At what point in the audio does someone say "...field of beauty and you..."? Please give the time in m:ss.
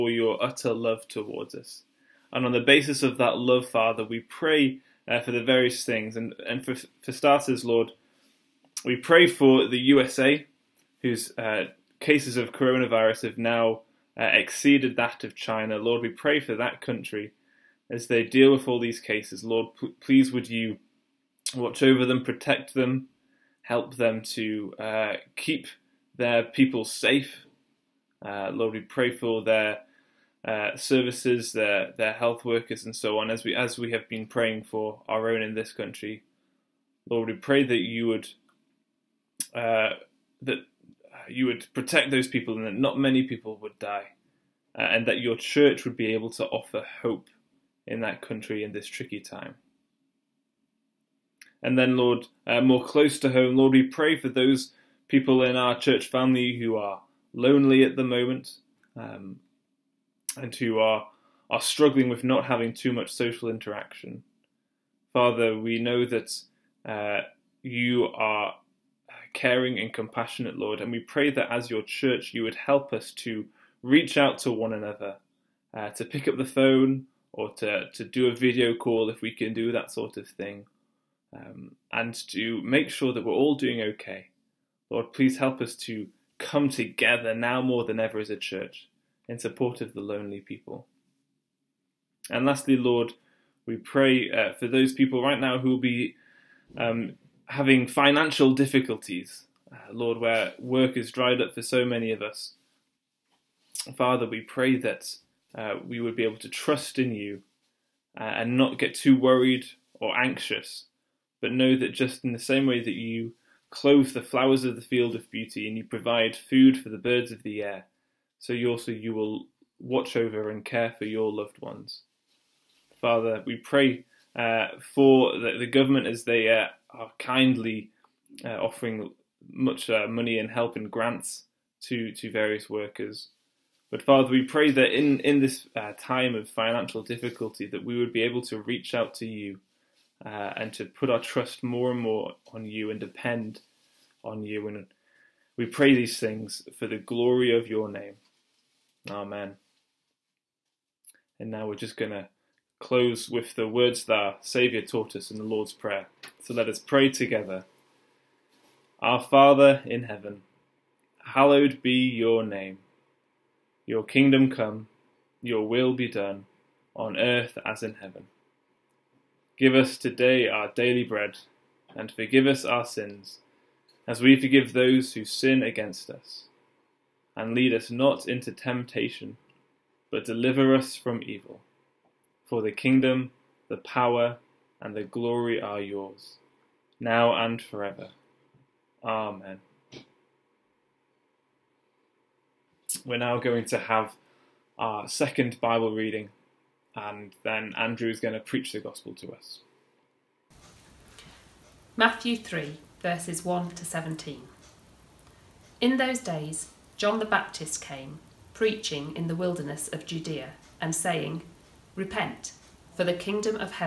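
1:54.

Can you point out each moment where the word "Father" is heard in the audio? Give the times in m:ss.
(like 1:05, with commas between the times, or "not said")
0:03, 1:05, 1:43, 2:02, 2:14, 2:39.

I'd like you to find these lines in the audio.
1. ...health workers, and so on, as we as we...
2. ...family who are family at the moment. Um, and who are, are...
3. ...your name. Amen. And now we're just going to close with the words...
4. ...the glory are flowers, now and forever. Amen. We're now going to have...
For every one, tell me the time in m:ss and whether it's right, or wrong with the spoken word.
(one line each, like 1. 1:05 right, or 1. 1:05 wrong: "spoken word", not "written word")
1. 0:32 right
2. 0:56 wrong: "lonely", not "family"
3. 2:27 right
4. 3:04 wrong: "yours", not "flowers".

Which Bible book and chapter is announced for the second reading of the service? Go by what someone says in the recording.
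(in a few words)
Matthew 3.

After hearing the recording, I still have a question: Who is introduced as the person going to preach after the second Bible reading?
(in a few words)
Andrew.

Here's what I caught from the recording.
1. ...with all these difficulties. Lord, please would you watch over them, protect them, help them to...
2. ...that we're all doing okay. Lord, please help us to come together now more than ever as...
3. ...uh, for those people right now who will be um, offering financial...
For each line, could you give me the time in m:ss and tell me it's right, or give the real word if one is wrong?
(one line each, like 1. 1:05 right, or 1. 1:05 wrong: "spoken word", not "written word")
1. 0:18 wrong: "cases", not "difficulties"
2. 1:23 right
3. 1:34 wrong: "having", not "offering".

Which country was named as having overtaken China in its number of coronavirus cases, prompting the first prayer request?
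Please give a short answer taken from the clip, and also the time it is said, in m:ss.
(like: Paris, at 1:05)
USA, at 0:09.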